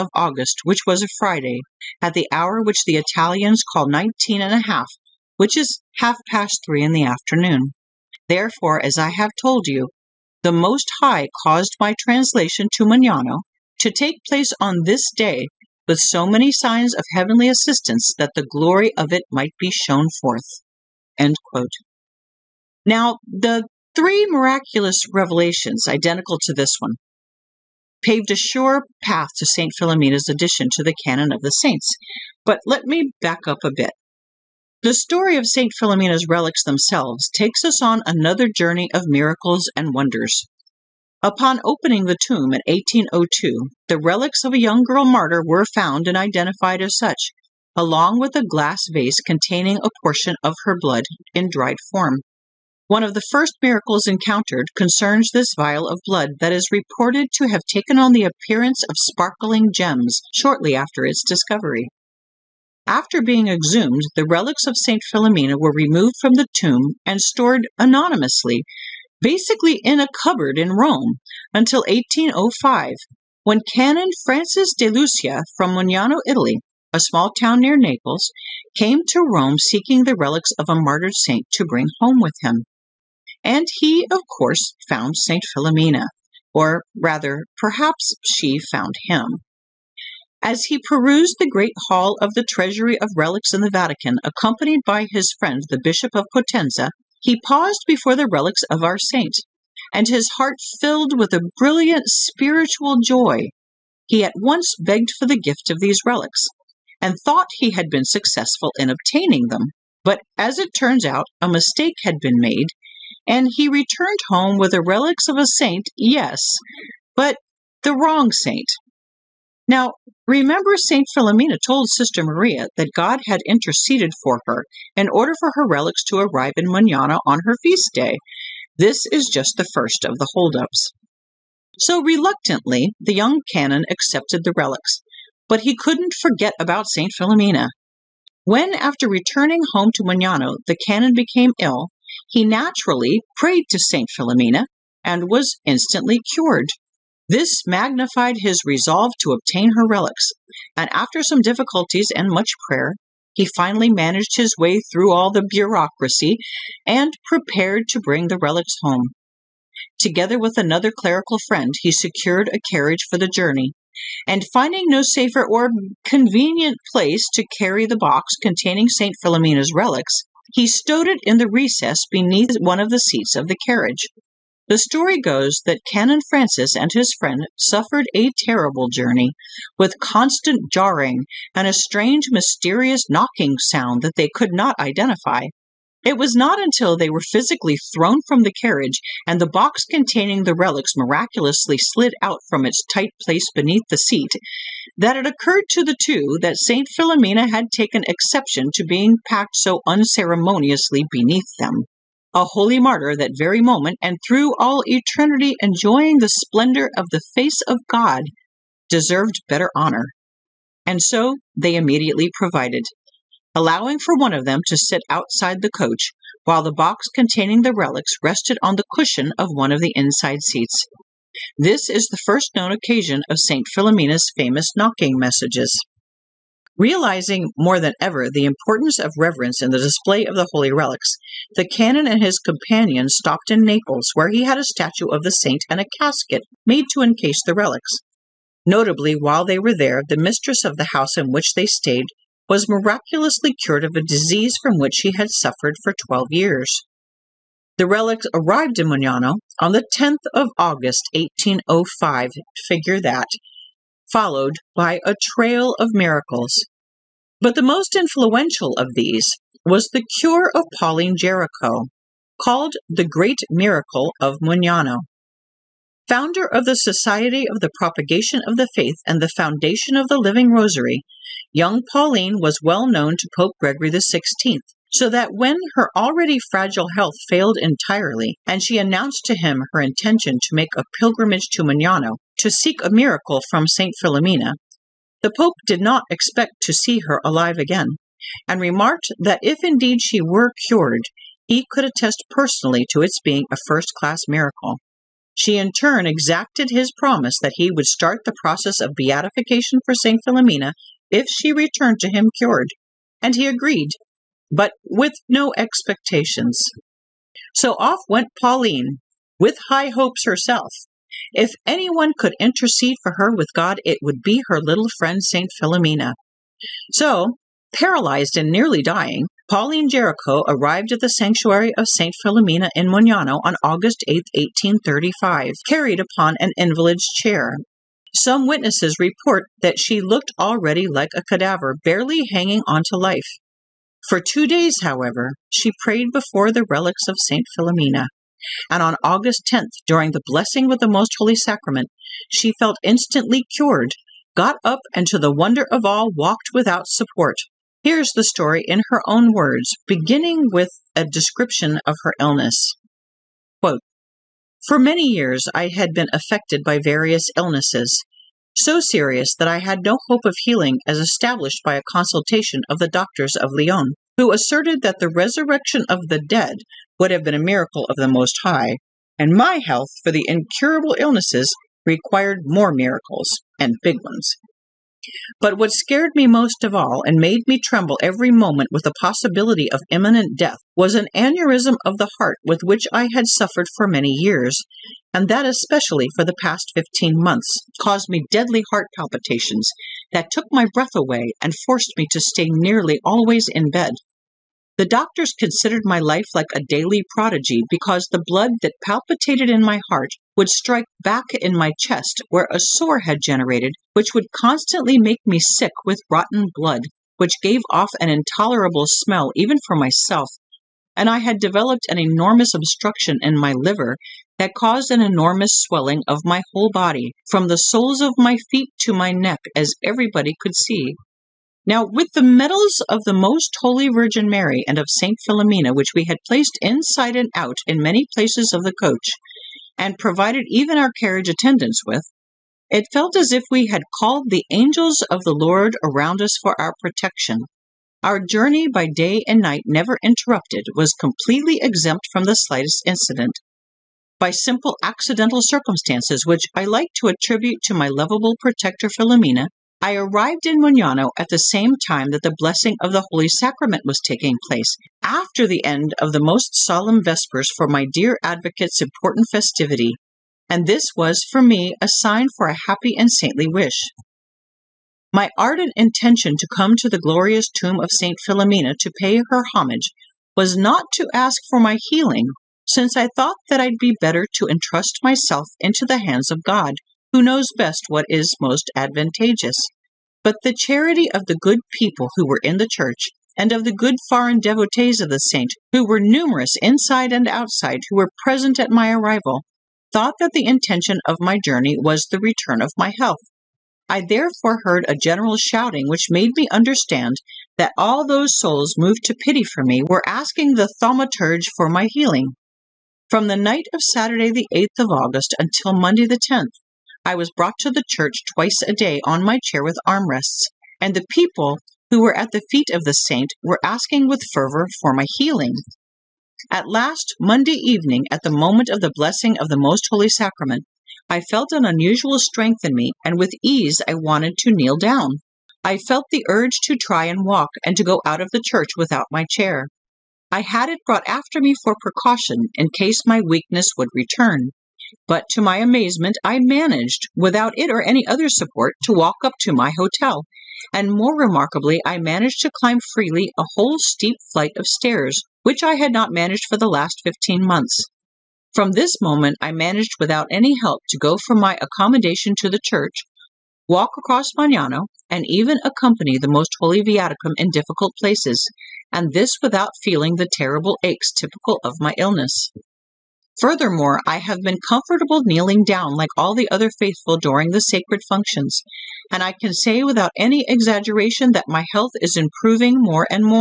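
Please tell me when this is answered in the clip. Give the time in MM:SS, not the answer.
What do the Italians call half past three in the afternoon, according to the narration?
00:03.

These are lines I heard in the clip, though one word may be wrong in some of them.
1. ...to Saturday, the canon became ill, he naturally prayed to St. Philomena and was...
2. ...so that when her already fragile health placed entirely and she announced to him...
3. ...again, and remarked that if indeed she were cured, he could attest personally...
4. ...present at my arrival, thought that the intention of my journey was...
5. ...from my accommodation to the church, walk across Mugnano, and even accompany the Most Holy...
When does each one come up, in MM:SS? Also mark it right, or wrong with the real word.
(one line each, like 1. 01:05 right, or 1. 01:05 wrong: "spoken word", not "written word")
1. 02:19 wrong: "Mugnano", not "Saturday"
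2. 04:34 wrong: "failed", not "placed"
3. 04:47 right
4. 08:08 right
5. 09:11 right.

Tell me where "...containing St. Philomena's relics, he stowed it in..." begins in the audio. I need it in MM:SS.
02:48.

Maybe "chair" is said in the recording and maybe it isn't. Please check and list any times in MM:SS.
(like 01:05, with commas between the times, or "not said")
05:27, 08:29, 08:49.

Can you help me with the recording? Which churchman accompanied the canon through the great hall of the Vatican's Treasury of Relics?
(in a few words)
Bishop of Potenza.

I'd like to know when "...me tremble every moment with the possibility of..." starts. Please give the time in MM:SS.
06:17.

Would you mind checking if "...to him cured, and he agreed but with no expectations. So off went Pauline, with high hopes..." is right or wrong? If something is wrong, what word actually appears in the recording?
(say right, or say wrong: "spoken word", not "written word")
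right.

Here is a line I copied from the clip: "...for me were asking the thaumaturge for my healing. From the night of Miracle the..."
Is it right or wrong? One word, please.
wrong.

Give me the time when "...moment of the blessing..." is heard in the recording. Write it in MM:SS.
08:38.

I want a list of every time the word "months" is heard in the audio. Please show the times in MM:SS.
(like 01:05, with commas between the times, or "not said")
06:27, 09:07.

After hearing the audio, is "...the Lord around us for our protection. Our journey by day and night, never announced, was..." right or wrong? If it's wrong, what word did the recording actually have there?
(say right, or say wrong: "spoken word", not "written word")
wrong: "interrupted", not "announced".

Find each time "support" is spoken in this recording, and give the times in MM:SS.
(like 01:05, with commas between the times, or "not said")
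05:46, 08:58.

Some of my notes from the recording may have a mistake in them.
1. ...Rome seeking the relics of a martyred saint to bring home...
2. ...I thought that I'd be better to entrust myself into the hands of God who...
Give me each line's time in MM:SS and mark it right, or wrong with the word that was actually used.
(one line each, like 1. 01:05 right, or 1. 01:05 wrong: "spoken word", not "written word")
1. 01:19 right
2. 07:52 right.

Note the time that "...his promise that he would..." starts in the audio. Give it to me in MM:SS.
04:56.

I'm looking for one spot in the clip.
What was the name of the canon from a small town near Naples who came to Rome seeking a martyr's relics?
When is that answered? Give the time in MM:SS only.
01:14.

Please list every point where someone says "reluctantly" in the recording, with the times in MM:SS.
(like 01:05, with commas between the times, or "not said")
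02:12.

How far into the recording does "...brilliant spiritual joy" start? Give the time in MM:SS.
01:41.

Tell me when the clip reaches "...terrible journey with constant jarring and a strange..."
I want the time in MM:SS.
02:58.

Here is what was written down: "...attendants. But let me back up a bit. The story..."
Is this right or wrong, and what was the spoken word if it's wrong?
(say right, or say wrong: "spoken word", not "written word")
wrong: "saints", not "attendants".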